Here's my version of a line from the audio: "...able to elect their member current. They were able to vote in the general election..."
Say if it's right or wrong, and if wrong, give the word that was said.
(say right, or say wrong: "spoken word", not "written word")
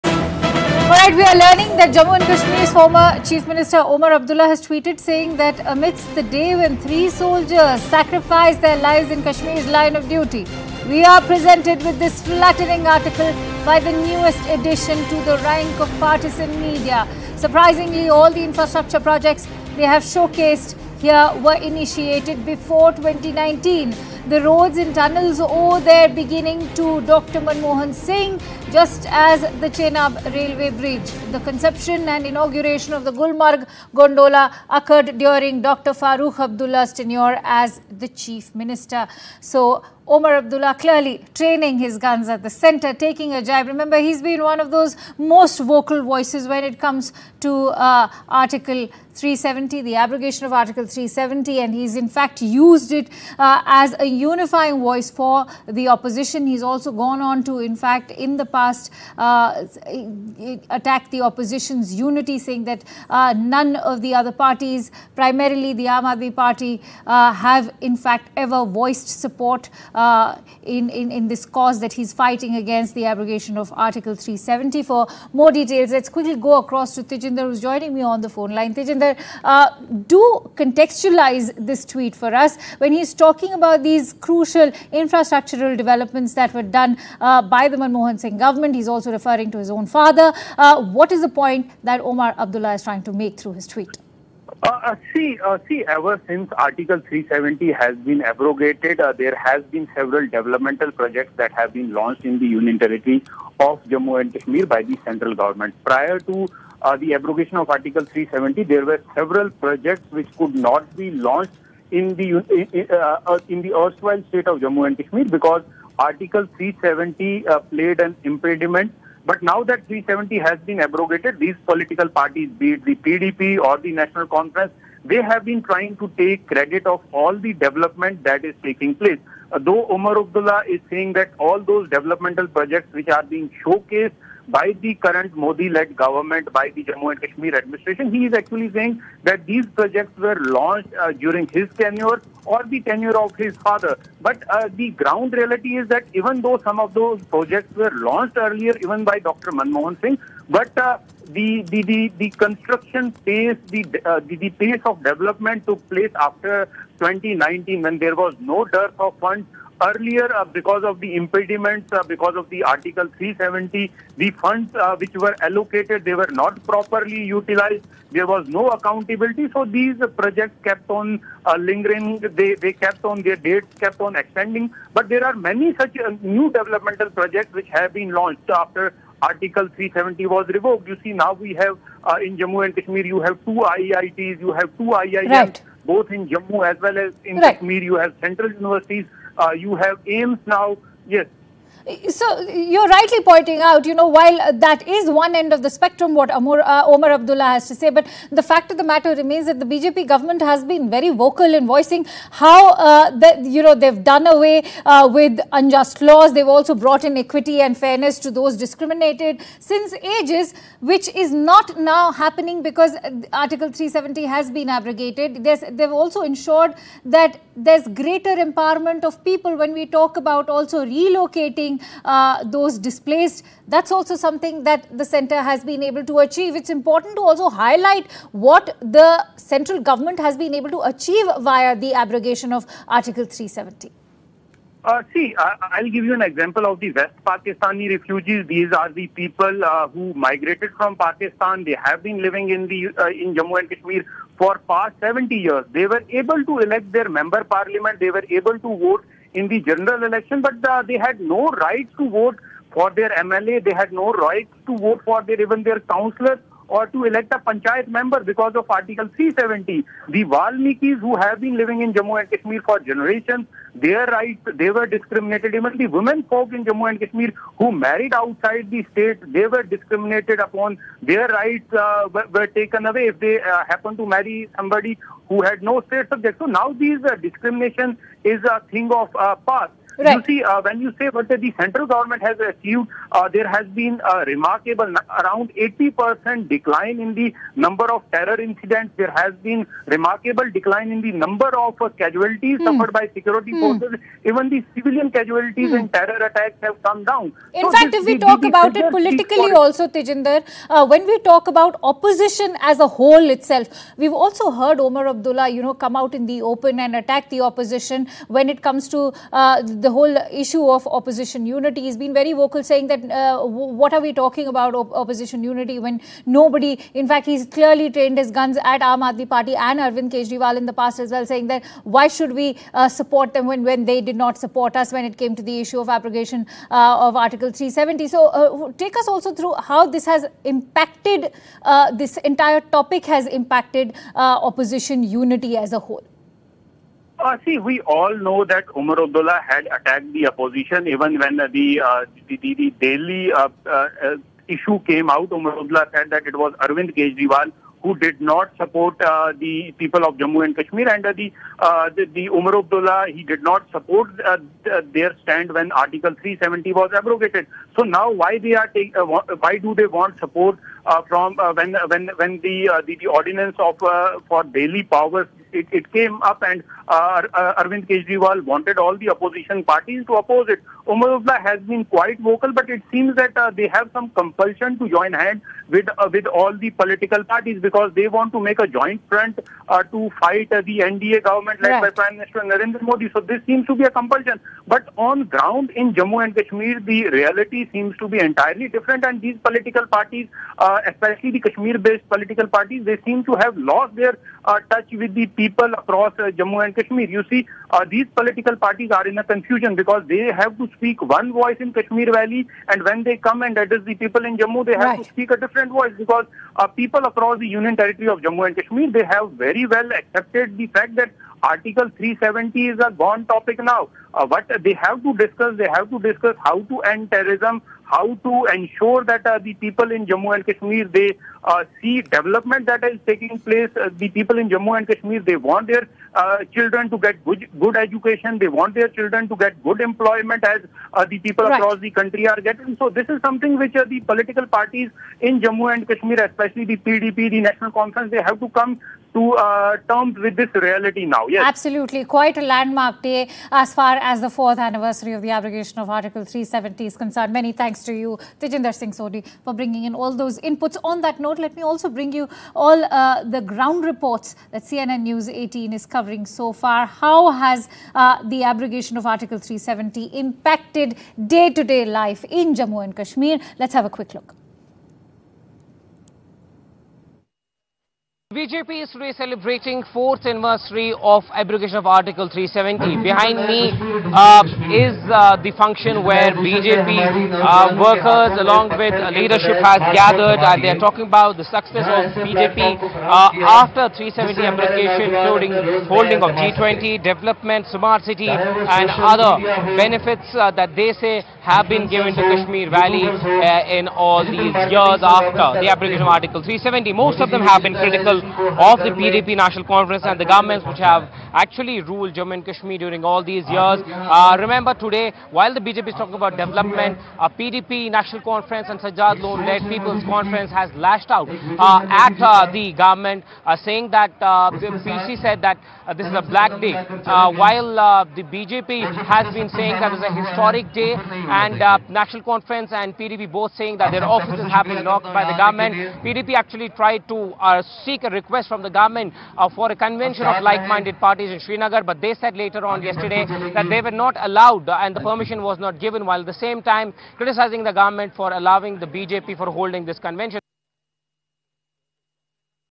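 wrong: "parliament", not "current".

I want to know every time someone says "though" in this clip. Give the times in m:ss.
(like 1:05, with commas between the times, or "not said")
2:09, 2:26.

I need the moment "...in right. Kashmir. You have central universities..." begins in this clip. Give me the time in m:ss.
3:07.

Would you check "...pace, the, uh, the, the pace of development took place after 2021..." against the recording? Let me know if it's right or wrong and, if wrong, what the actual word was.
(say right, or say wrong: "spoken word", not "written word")
wrong: "2019", not "2021".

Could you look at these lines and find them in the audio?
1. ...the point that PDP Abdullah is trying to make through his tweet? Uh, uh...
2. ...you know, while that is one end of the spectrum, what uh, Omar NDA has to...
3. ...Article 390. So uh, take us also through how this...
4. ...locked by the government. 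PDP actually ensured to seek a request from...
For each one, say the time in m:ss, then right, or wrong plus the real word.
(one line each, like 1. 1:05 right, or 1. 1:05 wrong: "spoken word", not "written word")
1. 1:31 wrong: "Omar", not "PDP"
2. 3:13 wrong: "Abdullah", not "NDA"
3. 5:27 wrong: "370", not "390"
4. 8:44 wrong: "tried", not "ensured".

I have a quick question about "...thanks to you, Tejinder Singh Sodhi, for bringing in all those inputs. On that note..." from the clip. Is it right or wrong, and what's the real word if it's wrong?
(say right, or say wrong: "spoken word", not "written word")
right.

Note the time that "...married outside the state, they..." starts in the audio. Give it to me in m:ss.
4:27.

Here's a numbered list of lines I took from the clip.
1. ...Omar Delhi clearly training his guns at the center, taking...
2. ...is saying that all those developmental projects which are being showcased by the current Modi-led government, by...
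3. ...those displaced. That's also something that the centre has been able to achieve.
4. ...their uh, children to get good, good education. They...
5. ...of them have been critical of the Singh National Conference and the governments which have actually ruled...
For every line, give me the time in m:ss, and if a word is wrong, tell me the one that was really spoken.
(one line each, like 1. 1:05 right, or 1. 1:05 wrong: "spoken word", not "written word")
1. 0:40 wrong: "Abdullah", not "Delhi"
2. 2:10 right
3. 3:42 right
4. 7:05 right
5. 8:17 wrong: "PDP", not "Singh".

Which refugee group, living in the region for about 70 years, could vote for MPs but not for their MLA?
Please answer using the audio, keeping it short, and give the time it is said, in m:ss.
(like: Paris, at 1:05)
West Pakistani refugees, at 3:56.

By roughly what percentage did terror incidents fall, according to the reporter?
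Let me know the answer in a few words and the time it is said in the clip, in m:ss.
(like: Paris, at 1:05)
80%, at 4:45.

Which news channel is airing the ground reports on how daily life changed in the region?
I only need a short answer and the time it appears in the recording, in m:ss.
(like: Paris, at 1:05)
CNN News 18, at 7:34.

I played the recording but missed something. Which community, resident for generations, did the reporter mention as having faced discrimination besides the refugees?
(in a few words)
Valmikis.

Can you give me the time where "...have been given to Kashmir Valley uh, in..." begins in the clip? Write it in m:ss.
8:11.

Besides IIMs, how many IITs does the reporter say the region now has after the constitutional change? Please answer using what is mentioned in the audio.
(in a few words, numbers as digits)
2.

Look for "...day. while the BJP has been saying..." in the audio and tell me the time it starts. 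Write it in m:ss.
8:36.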